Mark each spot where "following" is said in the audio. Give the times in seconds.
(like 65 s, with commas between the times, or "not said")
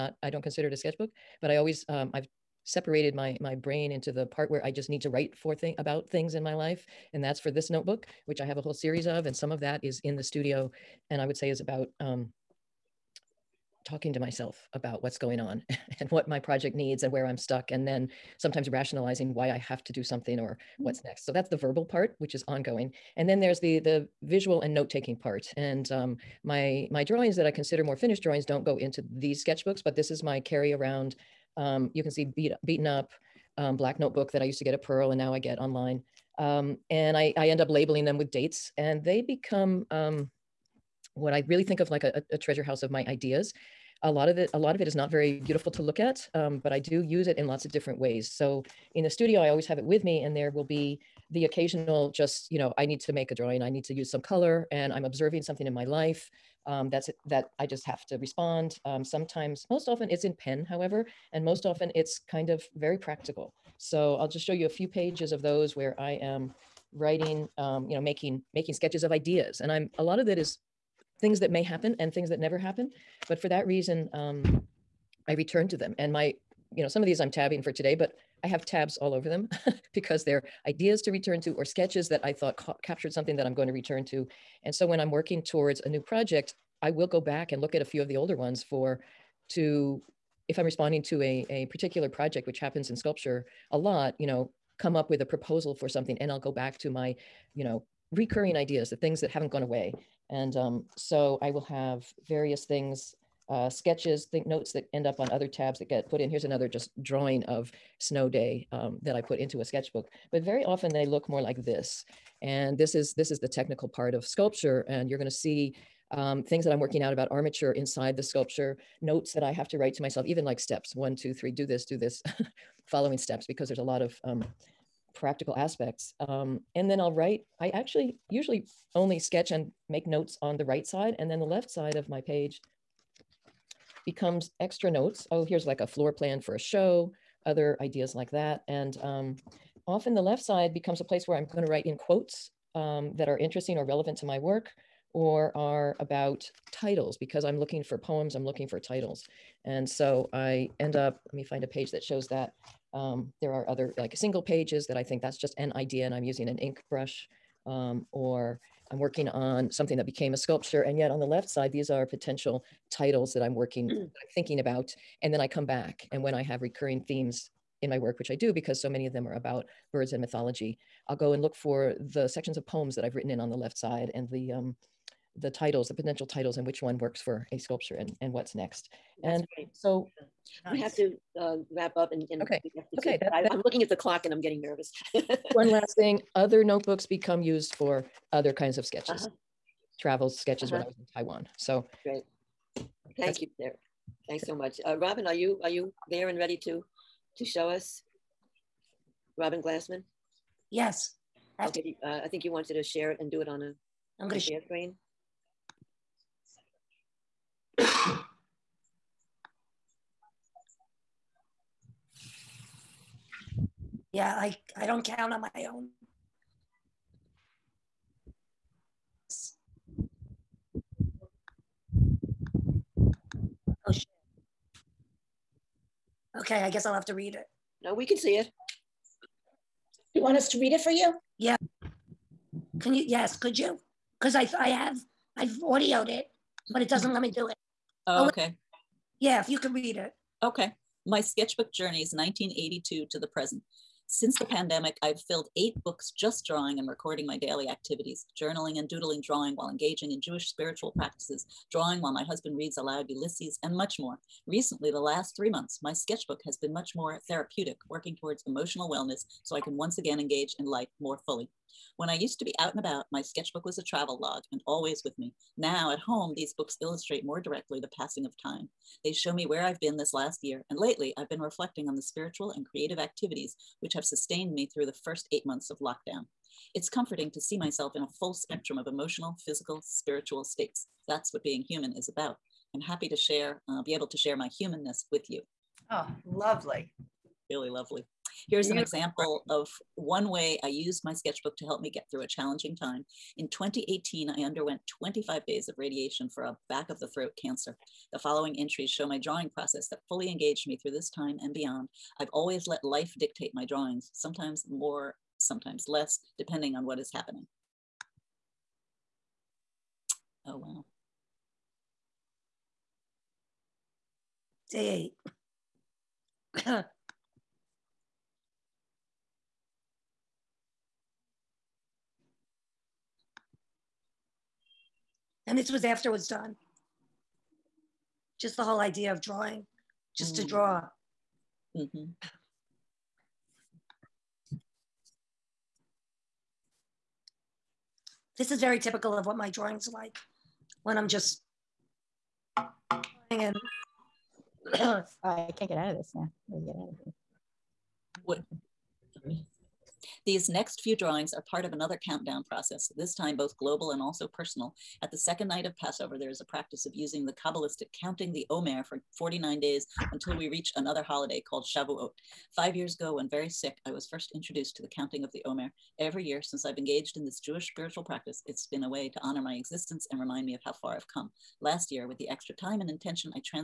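122 s, 298 s.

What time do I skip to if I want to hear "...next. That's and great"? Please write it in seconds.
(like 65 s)
178 s.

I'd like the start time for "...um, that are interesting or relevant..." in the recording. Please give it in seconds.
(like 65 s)
142 s.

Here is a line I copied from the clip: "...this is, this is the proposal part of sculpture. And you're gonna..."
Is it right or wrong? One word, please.
wrong.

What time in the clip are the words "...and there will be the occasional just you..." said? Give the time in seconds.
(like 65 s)
50 s.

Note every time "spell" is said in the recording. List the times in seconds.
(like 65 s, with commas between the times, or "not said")
not said.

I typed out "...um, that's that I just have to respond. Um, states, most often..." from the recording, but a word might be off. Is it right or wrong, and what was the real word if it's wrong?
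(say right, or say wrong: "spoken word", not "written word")
wrong: "sometimes", not "states".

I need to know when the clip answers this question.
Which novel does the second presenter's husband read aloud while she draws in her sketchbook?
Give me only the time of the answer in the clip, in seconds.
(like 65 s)
253 s.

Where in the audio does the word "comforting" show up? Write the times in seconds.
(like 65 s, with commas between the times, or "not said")
276 s.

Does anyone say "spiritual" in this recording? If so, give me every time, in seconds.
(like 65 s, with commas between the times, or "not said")
250 s, 272 s, 279 s, 367 s.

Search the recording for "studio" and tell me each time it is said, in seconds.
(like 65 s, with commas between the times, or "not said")
10 s, 49 s.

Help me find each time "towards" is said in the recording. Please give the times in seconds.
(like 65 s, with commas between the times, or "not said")
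85 s, 258 s.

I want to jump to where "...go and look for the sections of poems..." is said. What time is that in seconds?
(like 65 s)
171 s.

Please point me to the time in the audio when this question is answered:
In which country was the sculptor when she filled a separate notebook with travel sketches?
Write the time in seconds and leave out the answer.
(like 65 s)
191 s.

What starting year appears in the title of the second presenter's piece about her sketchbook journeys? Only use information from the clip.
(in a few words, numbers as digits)
1982.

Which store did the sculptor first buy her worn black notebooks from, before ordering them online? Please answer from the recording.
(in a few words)
Pearl.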